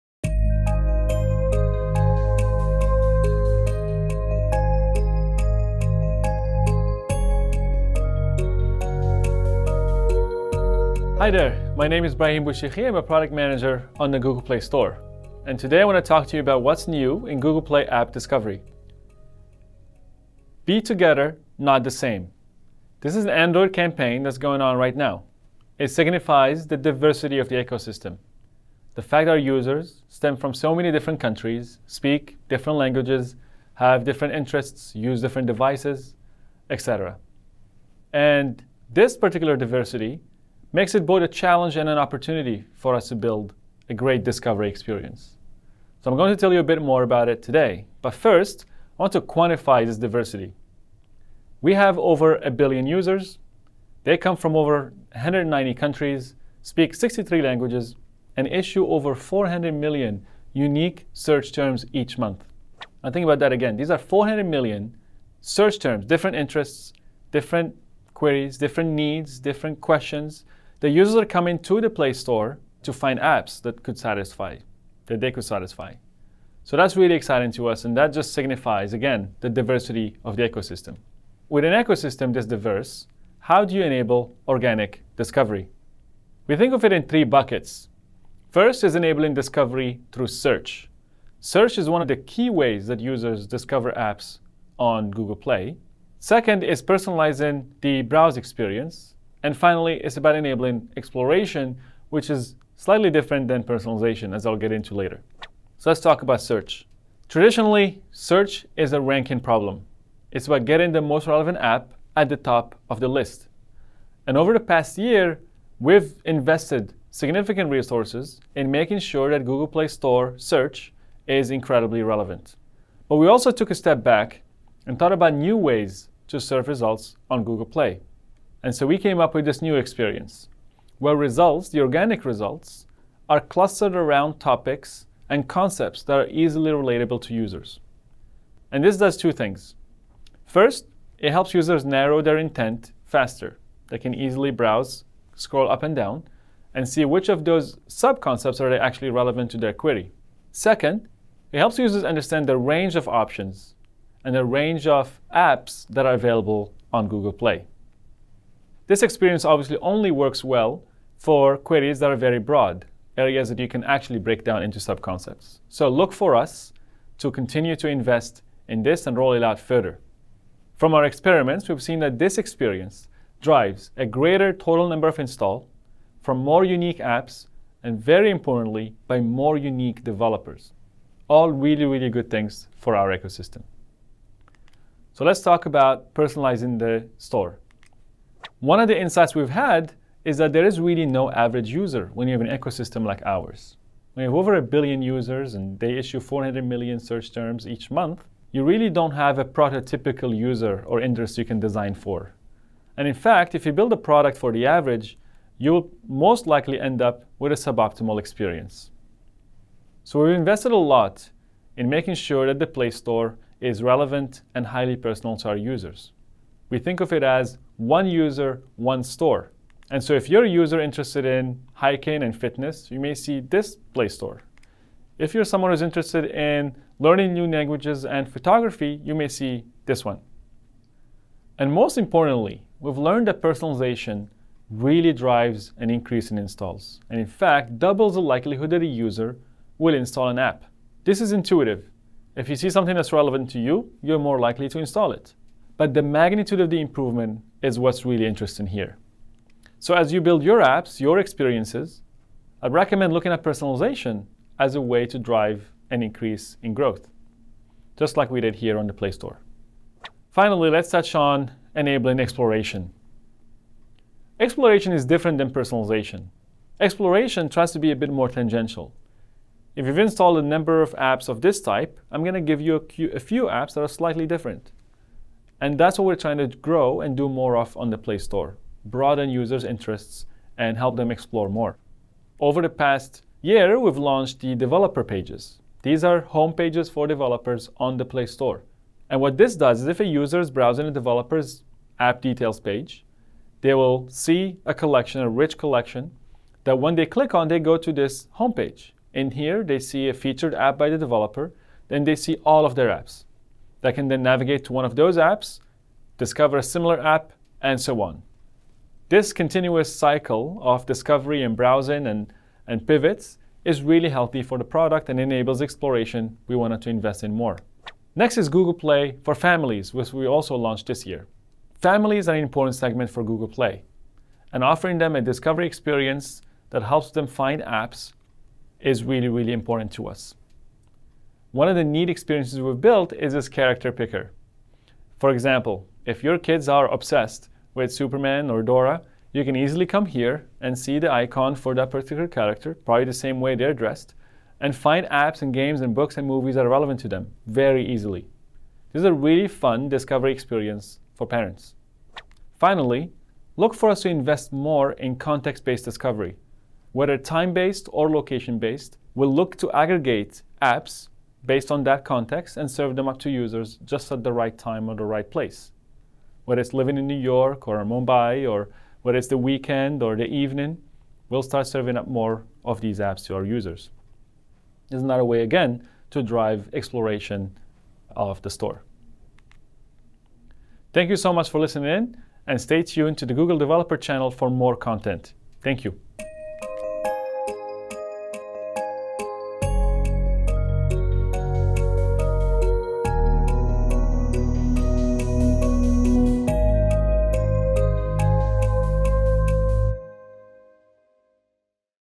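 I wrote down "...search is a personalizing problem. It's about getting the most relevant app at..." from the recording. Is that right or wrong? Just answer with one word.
wrong.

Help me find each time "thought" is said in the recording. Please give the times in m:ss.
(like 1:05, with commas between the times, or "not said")
2:04.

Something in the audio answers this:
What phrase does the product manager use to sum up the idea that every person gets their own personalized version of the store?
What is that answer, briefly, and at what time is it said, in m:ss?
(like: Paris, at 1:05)
One user, one store, at 3:37.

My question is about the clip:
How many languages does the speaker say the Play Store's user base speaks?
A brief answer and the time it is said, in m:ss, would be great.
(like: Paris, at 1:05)
63, at 0:56.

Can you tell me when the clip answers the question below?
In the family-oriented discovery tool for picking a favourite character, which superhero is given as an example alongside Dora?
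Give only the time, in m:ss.
5:37.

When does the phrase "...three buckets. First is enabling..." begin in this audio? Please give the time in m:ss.
1:27.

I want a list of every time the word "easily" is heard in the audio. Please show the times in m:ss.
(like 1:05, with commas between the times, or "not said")
2:16, 2:24, 5:39, 5:47.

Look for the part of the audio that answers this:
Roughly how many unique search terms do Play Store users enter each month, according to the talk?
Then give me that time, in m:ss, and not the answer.
0:59.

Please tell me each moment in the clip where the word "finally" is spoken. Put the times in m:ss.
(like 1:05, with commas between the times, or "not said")
1:39, 4:20, 5:52.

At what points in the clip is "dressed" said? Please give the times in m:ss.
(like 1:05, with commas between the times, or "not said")
5:43.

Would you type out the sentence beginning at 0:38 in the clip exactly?
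And this particular diversity makes it both a challenge and an opportunity for us to build a great discovery experience.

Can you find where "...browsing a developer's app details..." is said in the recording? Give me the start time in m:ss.
4:50.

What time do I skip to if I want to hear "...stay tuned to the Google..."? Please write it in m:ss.
6:22.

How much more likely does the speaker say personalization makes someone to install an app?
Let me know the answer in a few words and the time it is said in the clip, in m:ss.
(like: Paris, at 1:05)
Doubles, at 3:57.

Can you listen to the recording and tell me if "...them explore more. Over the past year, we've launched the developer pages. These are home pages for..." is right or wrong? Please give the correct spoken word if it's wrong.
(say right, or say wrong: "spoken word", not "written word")
right.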